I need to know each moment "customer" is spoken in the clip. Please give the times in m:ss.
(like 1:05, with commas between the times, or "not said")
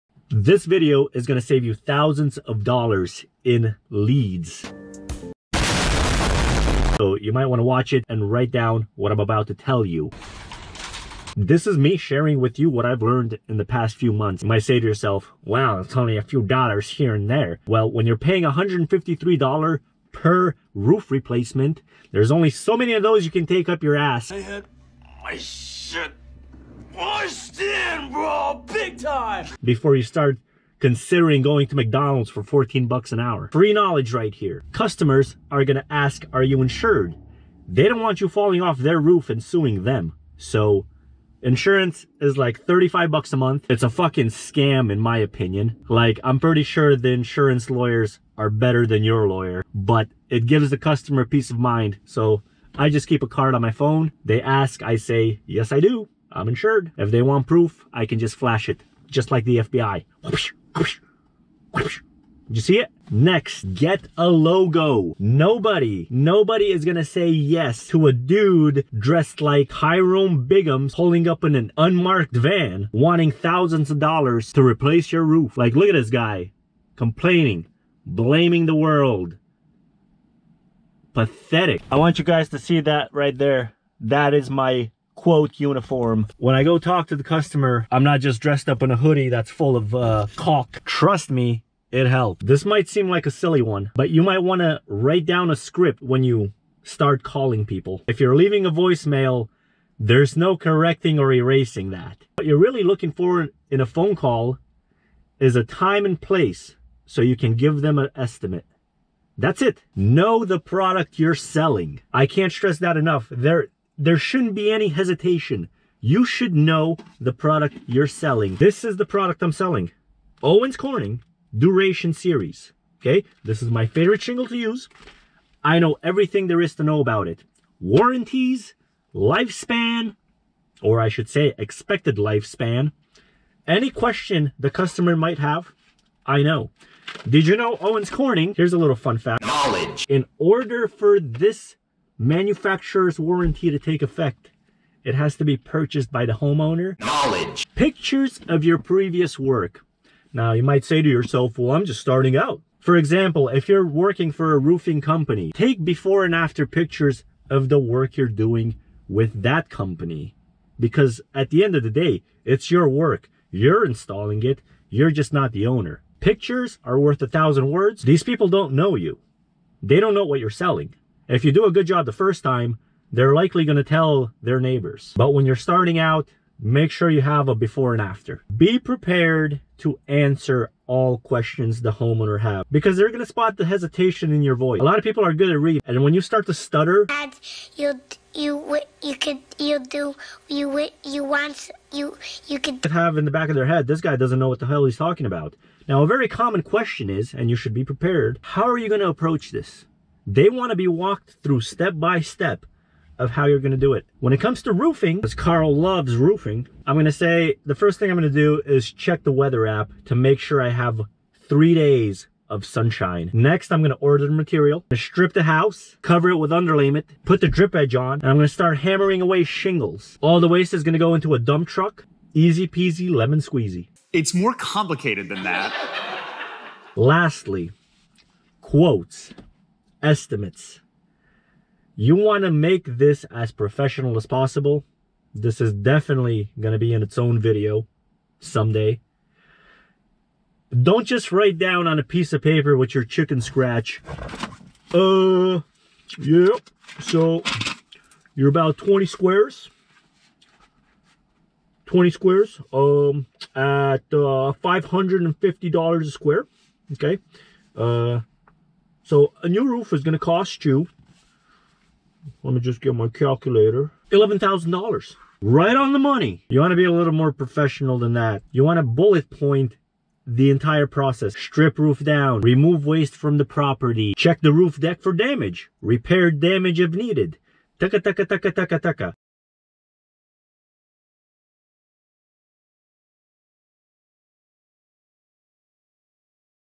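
0:34, 0:50, 1:27, 2:14.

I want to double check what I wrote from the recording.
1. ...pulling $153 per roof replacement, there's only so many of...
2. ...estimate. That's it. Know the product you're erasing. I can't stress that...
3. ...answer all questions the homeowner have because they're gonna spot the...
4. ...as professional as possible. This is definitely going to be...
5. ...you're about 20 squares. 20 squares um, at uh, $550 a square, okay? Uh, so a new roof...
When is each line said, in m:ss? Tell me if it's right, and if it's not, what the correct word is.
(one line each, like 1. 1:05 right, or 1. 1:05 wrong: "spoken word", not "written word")
1. 0:18 wrong: "paying", not "pulling"
2. 1:48 wrong: "selling", not "erasing"
3. 3:00 right
4. 3:53 right
5. 4:08 right.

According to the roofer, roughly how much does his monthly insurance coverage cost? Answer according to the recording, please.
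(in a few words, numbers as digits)
$35.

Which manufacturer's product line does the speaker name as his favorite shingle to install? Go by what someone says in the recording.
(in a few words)
Owens Corning Duration Series.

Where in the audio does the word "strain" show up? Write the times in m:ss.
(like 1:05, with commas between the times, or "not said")
not said.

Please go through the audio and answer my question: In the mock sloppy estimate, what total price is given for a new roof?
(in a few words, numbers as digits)
$11,000.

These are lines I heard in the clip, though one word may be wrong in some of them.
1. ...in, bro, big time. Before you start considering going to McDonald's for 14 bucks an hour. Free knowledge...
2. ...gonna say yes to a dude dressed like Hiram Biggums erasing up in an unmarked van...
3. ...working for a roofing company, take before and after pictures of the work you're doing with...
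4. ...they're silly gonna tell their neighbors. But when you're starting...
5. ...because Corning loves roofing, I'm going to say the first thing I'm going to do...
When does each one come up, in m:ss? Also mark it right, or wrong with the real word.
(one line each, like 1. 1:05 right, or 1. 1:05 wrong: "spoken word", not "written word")
1. 0:27 right
2. 1:06 wrong: "pulling", not "erasing"
3. 2:33 right
4. 2:53 wrong: "likely", not "silly"
5. 3:25 wrong: "Carl", not "Corning".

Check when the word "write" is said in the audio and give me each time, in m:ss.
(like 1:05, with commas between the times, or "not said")
0:08, 1:34, 4:01.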